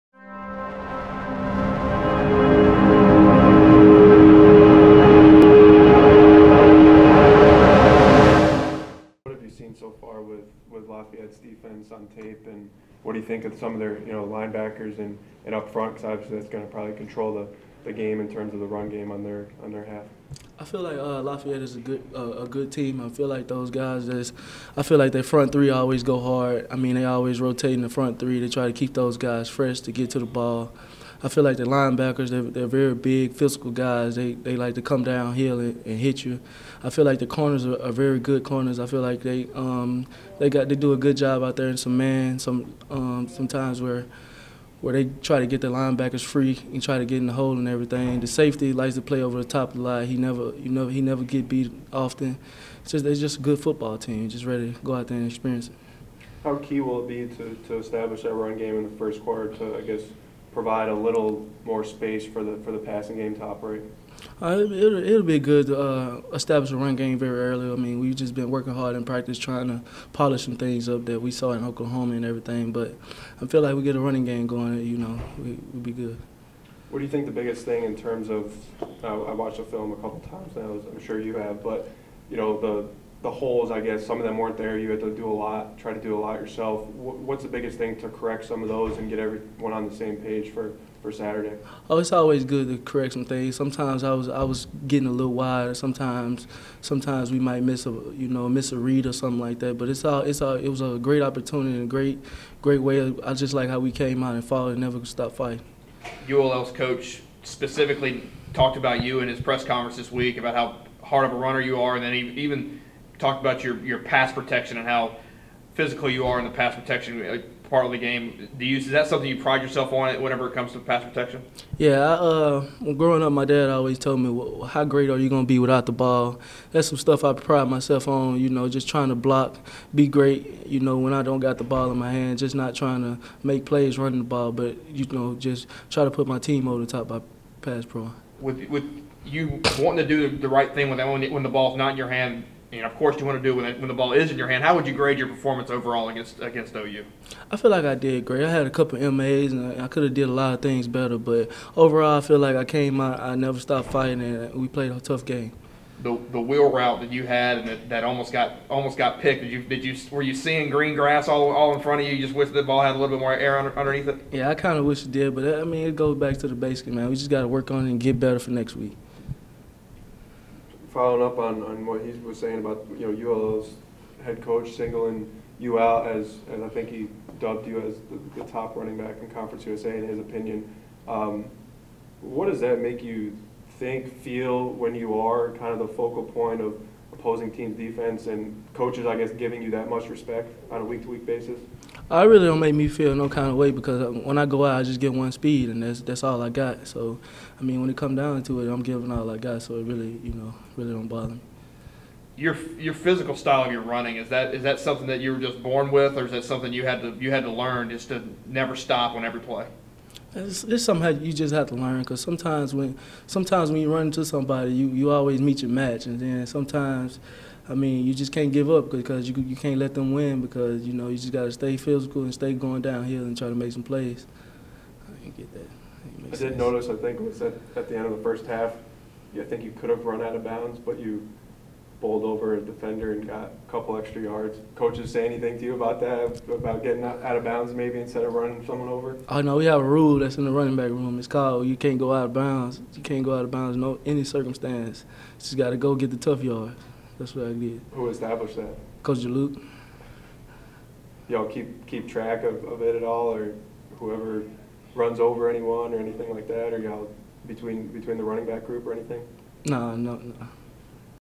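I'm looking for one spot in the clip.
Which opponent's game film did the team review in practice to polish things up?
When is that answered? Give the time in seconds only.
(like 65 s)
71 s.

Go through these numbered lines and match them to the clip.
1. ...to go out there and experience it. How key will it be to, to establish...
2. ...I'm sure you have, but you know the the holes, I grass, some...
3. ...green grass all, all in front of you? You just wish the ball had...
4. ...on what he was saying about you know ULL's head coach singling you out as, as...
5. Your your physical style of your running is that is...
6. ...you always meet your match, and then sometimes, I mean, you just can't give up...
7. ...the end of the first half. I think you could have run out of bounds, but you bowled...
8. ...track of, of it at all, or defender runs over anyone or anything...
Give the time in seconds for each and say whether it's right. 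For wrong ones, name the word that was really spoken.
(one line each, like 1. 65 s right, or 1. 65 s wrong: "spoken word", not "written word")
1. 54 s right
2. 80 s wrong: "guess", not "grass"
3. 160 s right
4. 171 s right
5. 202 s right
6. 214 s right
7. 227 s right
8. 252 s wrong: "whoever", not "defender".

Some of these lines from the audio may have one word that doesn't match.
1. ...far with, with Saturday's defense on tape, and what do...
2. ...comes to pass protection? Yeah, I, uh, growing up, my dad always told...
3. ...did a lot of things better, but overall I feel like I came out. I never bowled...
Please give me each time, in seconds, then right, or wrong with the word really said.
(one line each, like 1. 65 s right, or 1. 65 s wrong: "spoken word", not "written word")
1. 9 s wrong: "Lafayette", not "Saturday"
2. 120 s right
3. 150 s wrong: "stopped", not "bowled".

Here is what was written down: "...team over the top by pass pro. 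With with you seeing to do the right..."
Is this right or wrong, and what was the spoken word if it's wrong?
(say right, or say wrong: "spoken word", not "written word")
wrong: "wanting", not "seeing".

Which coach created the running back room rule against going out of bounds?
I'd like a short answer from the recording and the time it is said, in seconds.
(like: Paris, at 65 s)
Coach Juluke, at 249 s.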